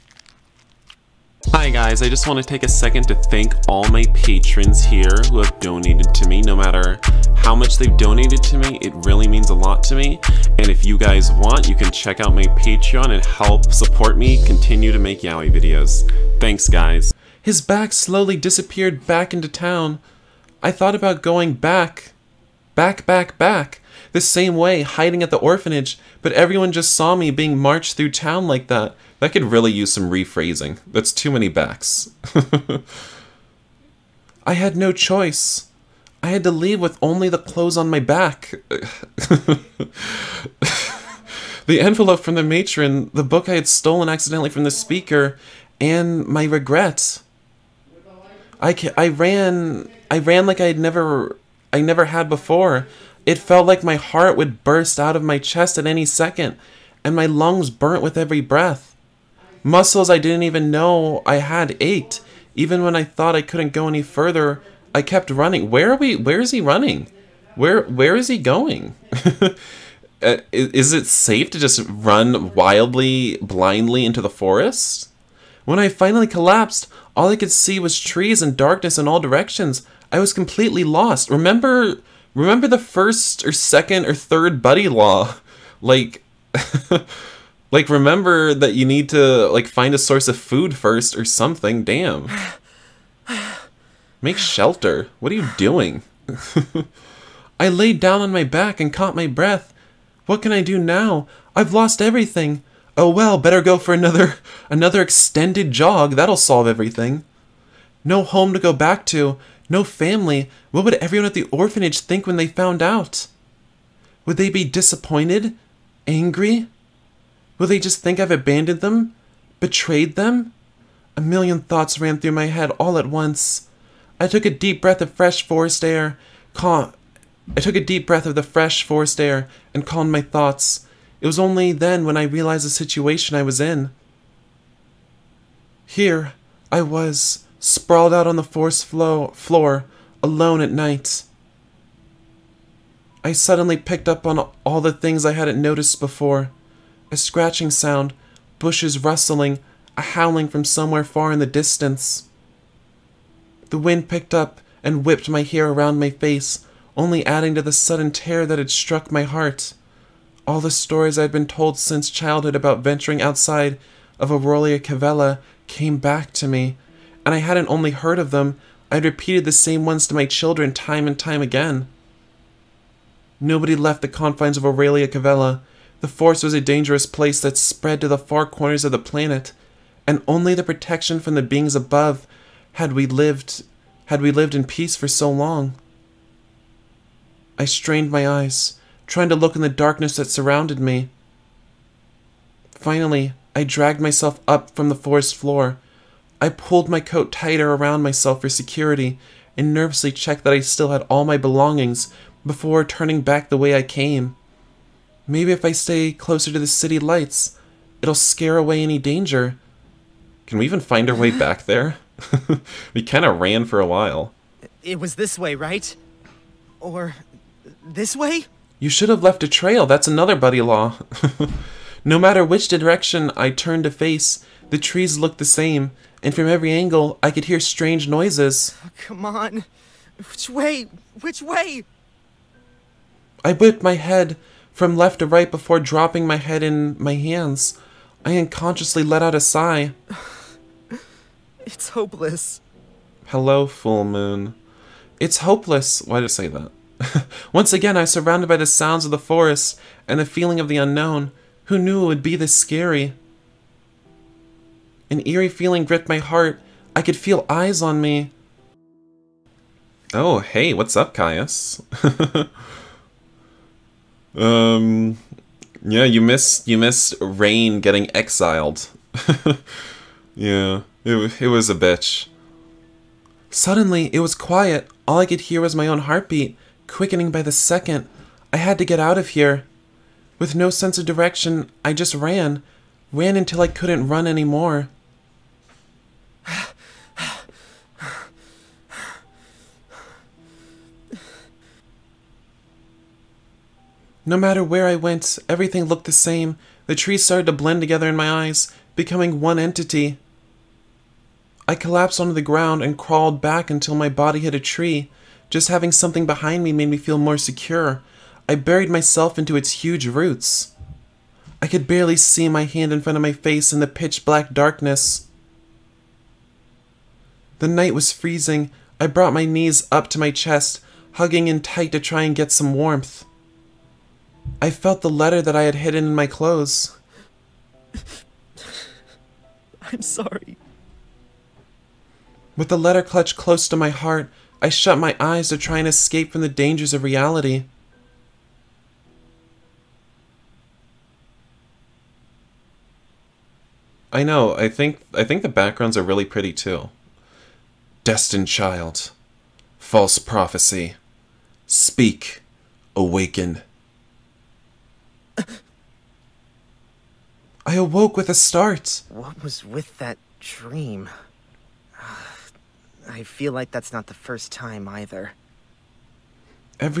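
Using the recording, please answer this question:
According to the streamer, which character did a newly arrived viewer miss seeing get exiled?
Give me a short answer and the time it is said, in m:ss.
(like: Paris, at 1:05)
Rain, at 4:27.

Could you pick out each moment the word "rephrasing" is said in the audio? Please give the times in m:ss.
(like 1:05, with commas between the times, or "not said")
0:30.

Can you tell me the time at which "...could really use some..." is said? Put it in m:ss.
0:29.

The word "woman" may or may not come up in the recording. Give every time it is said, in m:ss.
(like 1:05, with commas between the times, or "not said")
not said.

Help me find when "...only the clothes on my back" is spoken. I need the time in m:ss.
0:37.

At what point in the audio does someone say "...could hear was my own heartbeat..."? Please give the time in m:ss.
4:35.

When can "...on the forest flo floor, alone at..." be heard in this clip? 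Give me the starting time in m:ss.
2:18.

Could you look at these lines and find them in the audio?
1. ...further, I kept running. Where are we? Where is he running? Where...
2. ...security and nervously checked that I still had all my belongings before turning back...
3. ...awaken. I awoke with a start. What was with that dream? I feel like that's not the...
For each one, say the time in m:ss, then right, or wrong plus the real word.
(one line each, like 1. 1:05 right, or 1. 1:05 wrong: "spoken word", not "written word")
1. 1:04 right
2. 3:18 right
3. 5:52 right.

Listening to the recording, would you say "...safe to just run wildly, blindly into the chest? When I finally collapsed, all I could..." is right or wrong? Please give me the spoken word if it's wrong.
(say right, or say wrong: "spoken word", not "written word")
wrong: "forest", not "chest".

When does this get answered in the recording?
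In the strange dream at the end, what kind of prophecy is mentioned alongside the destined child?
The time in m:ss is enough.
5:49.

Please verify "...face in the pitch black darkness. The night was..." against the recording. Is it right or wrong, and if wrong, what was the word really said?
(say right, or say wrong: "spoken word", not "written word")
right.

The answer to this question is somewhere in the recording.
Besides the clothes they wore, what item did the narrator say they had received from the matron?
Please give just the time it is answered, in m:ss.
0:41.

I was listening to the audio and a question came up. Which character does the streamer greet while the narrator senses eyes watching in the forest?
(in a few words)
Caius.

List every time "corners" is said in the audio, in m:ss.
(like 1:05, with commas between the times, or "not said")
2:58.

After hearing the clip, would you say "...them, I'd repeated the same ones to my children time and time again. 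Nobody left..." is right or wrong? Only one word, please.
right.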